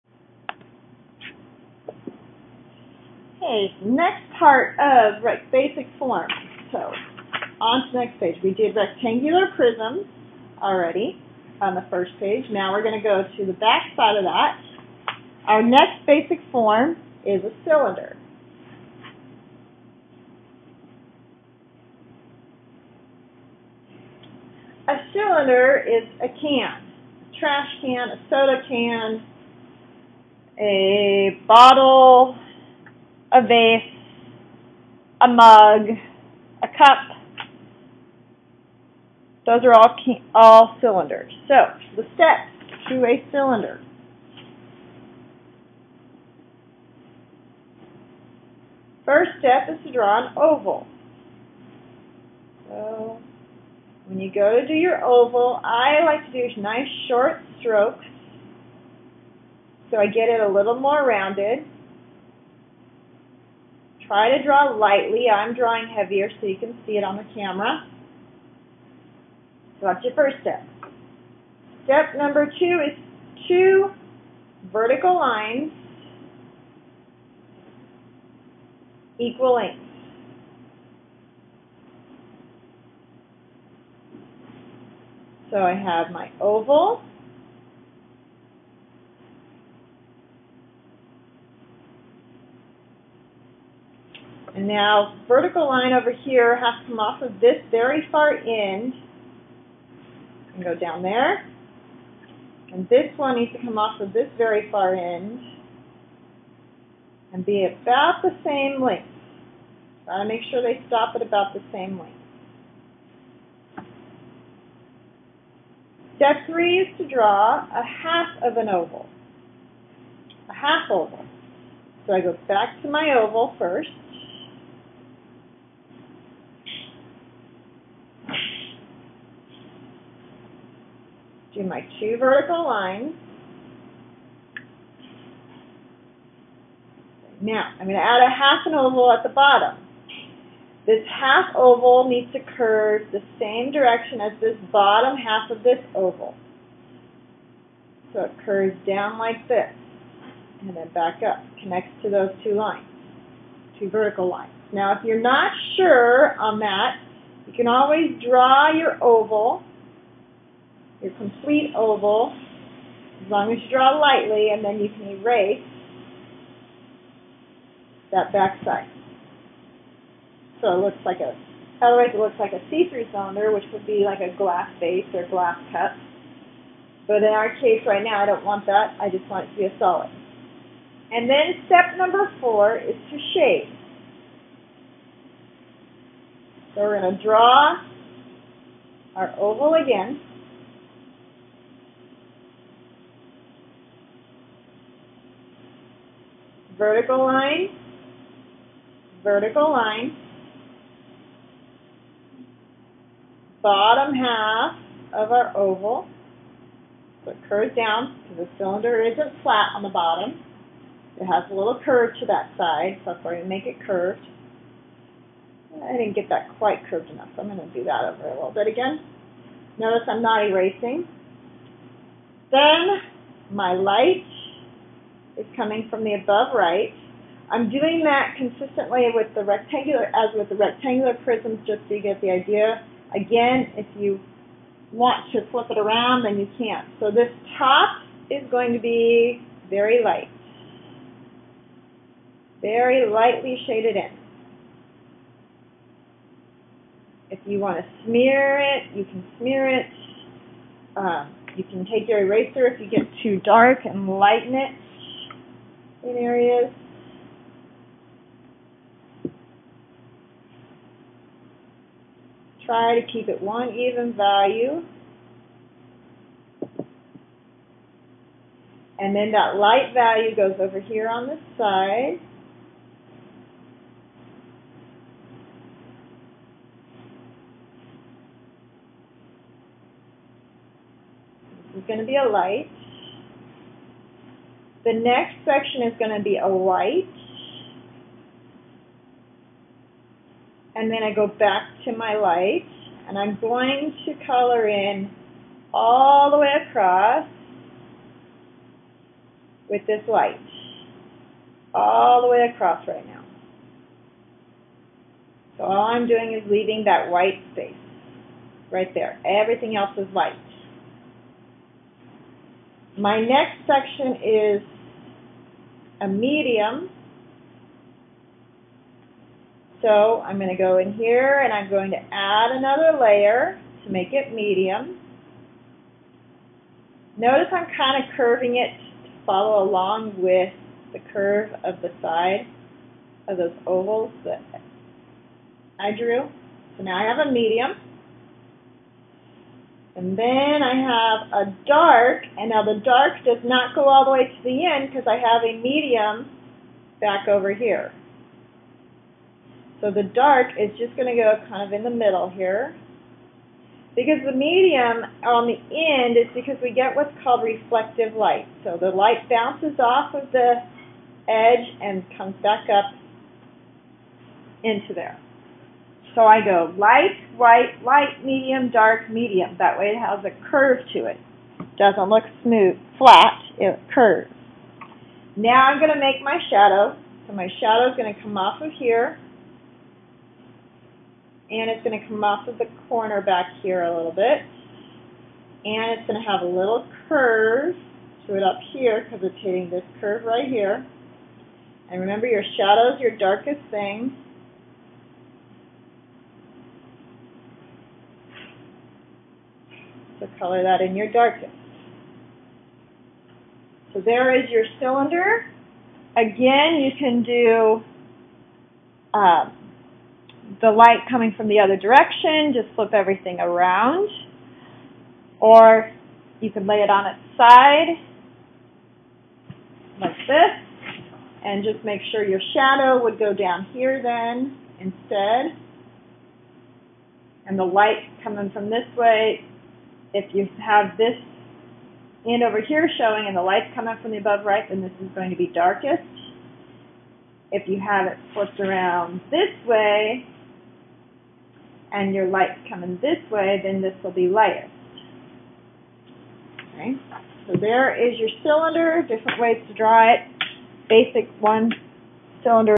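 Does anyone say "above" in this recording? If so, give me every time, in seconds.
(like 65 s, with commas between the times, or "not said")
226 s, 434 s.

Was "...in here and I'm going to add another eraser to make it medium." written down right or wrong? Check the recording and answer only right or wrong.
wrong.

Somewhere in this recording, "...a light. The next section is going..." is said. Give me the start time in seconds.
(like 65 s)
282 s.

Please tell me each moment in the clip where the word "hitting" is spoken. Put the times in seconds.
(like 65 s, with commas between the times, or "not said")
389 s.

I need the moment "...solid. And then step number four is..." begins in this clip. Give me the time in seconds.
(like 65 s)
179 s.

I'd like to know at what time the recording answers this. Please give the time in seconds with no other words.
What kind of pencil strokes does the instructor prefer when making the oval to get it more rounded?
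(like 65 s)
57 s.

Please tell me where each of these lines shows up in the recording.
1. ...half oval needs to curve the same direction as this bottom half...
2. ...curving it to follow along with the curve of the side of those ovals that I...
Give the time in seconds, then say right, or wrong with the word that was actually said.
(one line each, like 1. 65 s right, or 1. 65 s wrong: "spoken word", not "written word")
1. 141 s right
2. 328 s right.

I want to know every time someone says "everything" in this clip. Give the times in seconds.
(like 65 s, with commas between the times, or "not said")
309 s, 412 s.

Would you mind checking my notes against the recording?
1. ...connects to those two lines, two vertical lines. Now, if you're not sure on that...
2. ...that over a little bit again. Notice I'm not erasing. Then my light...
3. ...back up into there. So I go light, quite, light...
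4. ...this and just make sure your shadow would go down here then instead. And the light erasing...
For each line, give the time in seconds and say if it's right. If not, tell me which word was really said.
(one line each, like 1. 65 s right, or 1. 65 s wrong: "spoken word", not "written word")
1. 151 s right
2. 217 s right
3. 362 s wrong: "white", not "quite"
4. 420 s wrong: "coming", not "erasing".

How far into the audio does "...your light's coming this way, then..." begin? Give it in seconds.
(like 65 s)
442 s.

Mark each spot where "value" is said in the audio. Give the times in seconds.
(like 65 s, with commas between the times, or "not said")
264 s, 269 s.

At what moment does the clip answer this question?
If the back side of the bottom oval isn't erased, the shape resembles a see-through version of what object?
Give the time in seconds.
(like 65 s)
175 s.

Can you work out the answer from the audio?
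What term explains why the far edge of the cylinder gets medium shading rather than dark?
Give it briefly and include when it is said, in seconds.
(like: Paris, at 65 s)
reflective light, at 357 s.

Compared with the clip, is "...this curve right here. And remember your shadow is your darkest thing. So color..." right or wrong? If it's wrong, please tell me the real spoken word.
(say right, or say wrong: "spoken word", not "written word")
right.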